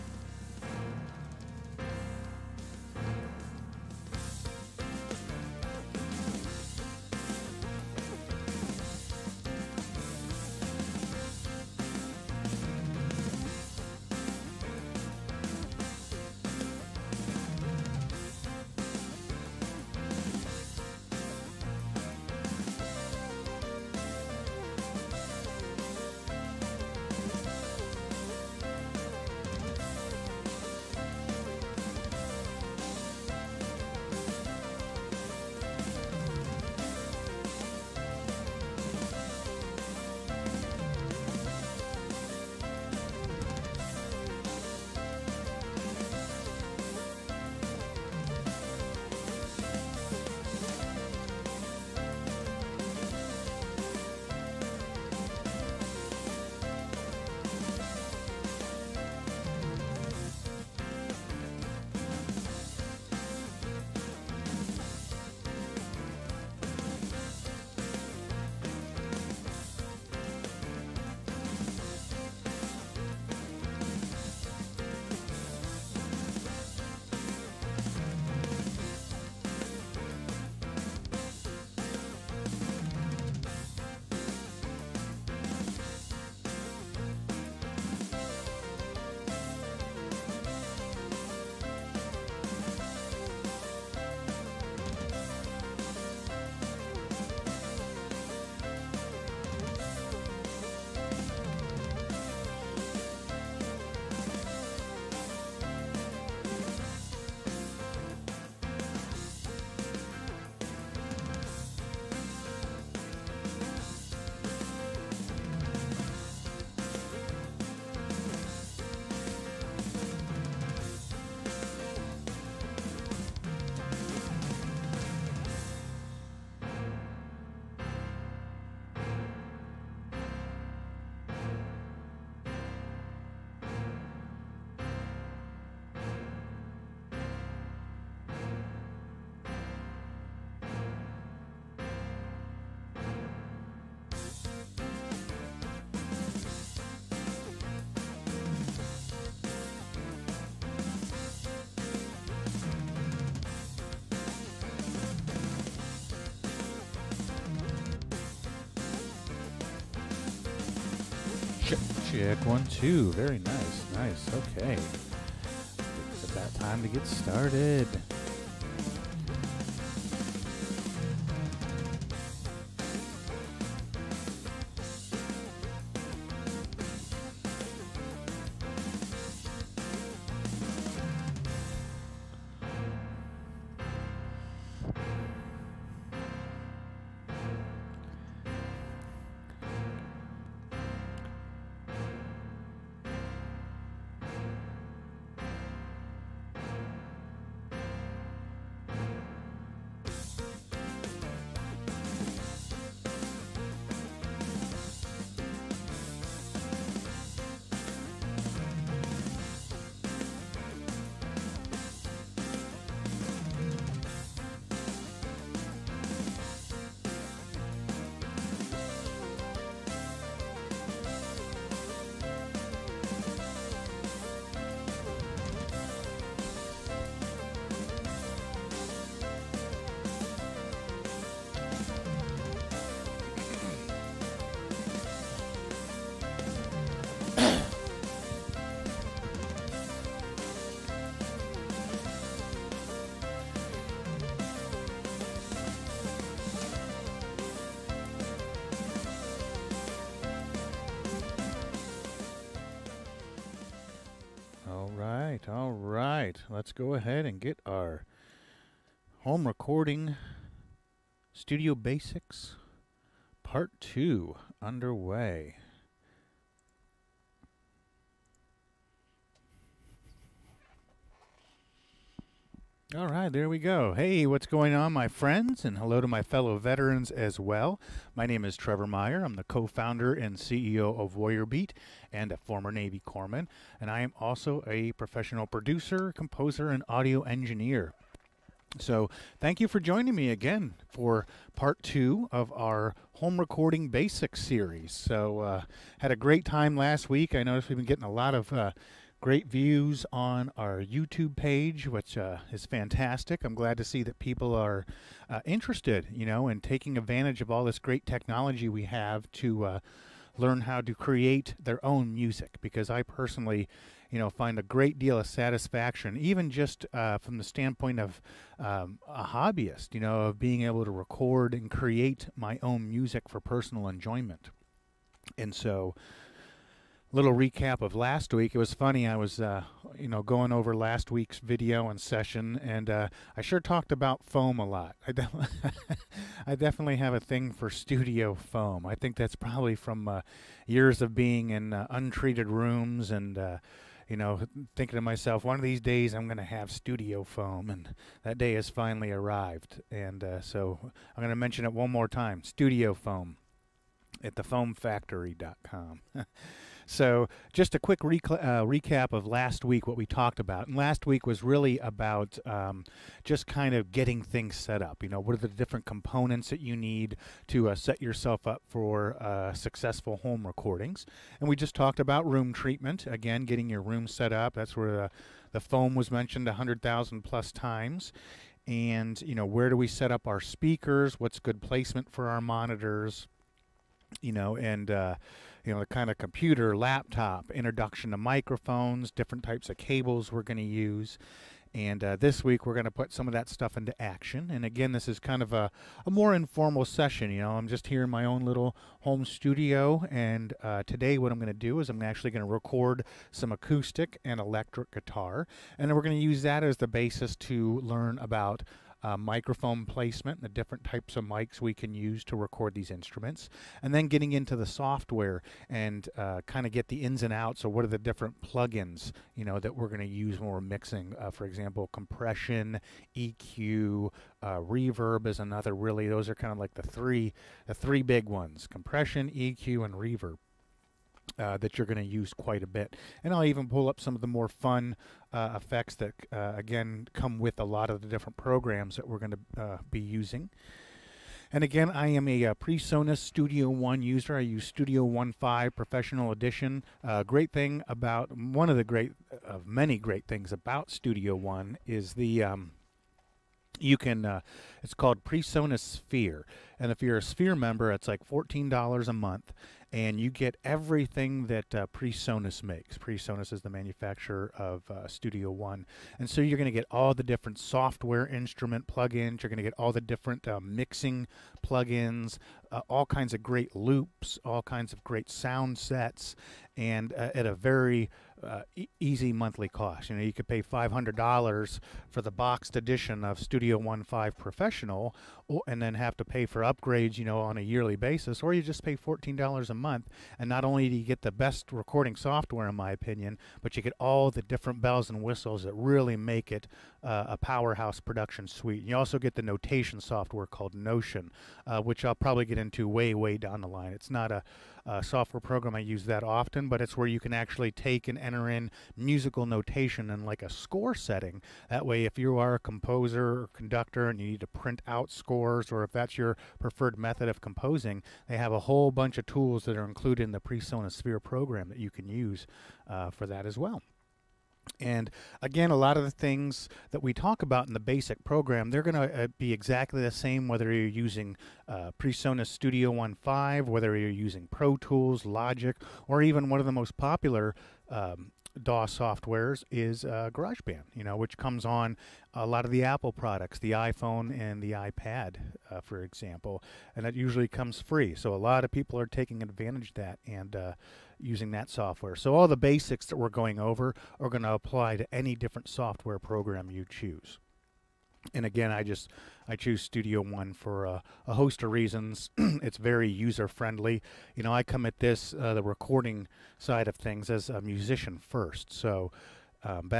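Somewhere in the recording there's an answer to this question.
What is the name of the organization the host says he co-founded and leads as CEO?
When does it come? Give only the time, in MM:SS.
04:41.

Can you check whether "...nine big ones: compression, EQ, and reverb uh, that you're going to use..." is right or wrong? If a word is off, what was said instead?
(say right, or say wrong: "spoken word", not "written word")
wrong: "three", not "nine".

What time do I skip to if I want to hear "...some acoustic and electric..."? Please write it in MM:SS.
06:43.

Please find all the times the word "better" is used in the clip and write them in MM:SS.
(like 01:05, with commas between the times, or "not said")
not said.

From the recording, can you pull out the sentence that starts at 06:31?
And uh, this week we're going to put some of that stuff into action.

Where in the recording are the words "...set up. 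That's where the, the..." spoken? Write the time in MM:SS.
06:14.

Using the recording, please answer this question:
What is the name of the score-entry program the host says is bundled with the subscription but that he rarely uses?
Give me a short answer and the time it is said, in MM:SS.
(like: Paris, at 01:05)
Notion, at 08:20.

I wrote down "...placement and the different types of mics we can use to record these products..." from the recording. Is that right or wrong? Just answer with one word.
wrong.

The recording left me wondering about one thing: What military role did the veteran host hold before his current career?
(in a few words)
Navy corpsman.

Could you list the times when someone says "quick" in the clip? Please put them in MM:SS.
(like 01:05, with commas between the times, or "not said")
05:57.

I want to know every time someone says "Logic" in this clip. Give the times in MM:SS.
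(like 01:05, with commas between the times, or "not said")
08:55.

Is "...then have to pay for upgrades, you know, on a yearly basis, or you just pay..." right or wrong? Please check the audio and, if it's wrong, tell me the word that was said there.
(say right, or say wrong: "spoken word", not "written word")
right.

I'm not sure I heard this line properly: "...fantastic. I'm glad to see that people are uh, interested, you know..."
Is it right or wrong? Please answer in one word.
right.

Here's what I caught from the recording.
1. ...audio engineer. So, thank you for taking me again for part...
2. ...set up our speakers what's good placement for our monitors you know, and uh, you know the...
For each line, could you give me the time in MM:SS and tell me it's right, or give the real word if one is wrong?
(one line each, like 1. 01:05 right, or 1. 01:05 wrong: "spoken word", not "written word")
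1. 04:46 wrong: "joining", not "taking"
2. 06:19 right.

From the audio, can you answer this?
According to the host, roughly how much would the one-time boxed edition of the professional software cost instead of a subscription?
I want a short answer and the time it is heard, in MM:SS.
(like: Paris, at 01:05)
$500, at 08:00.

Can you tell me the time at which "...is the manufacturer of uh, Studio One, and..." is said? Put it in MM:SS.
07:43.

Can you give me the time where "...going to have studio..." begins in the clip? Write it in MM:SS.
05:46.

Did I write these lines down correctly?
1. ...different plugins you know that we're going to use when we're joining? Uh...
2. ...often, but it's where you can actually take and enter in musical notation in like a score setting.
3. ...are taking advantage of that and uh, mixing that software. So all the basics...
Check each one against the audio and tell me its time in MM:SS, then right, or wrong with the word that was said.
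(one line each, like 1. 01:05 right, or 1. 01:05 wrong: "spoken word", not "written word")
1. 06:57 wrong: "mixing", not "joining"
2. 08:26 right
3. 09:08 wrong: "using", not "mixing".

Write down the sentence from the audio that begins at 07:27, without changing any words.
Uh, great thing about one of the great, uh, of many great things about Studio One is the.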